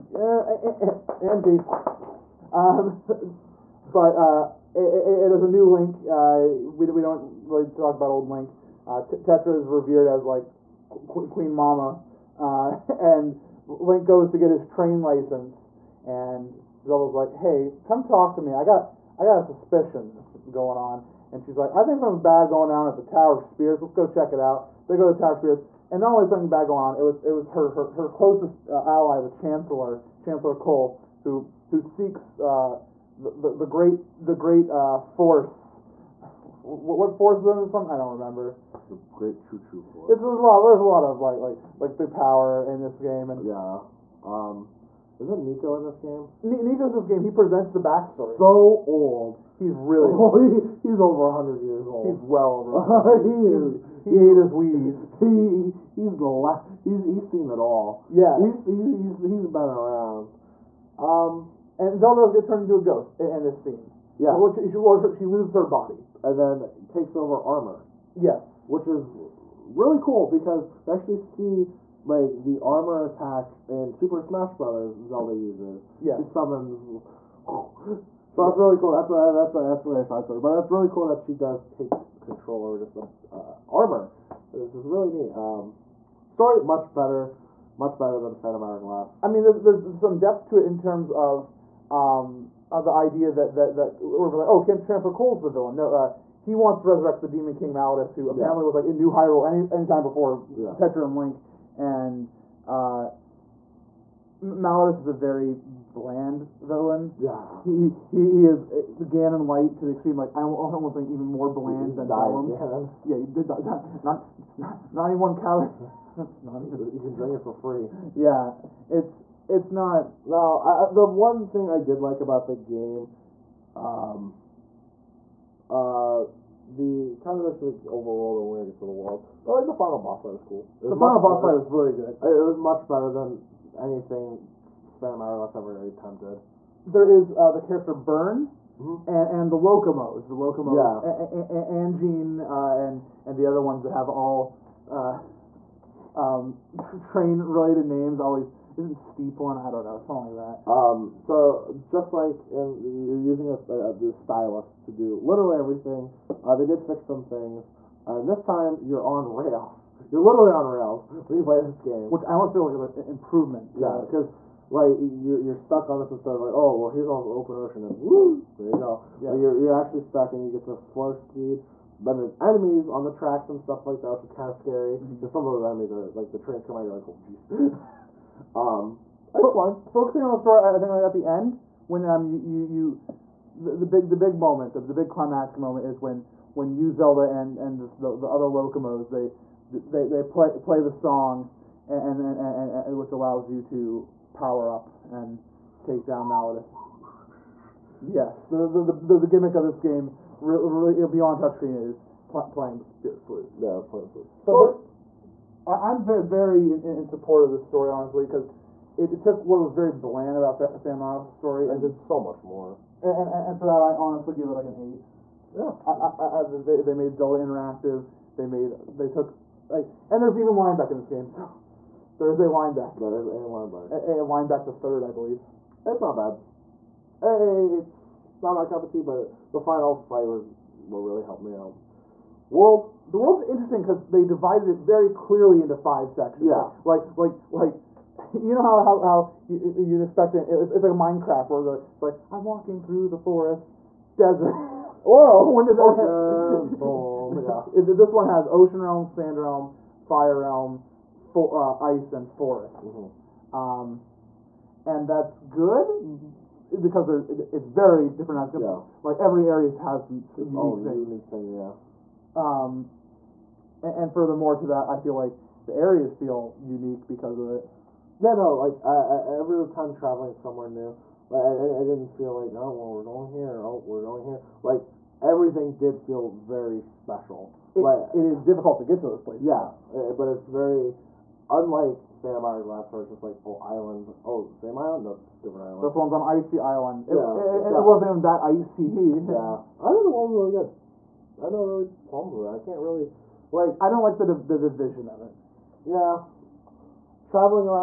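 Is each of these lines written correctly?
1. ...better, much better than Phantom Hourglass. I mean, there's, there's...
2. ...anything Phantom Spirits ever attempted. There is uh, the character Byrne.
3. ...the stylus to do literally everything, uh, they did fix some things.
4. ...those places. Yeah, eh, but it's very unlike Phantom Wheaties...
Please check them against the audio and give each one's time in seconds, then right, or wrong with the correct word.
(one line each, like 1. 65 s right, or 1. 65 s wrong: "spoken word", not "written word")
1. 86 s right
2. 133 s wrong: "Hourglass", not "Spirits"
3. 153 s right
4. 279 s wrong: "Hourglass", not "Wheaties".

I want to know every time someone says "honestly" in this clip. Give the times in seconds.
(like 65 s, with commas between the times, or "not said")
207 s, 213 s.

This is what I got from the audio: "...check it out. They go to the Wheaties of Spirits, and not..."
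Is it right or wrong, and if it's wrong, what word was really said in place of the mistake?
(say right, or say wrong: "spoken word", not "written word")
wrong: "Tower", not "Wheaties".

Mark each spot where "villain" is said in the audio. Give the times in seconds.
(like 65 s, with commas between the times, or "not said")
95 s, 106 s.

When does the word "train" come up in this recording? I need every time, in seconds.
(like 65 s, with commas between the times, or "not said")
14 s, 146 s, 176 s.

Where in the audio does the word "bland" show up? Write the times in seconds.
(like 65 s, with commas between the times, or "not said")
105 s, 111 s, 209 s.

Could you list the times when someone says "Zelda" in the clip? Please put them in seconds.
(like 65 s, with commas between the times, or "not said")
16 s, 61 s, 75 s, 186 s, 217 s.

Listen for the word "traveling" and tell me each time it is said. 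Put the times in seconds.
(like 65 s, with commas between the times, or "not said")
269 s, 297 s.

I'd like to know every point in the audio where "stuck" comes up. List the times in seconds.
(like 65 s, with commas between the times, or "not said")
165 s, 169 s.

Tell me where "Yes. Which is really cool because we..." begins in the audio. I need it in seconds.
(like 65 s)
68 s.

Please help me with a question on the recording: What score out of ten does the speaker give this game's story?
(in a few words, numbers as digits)
8.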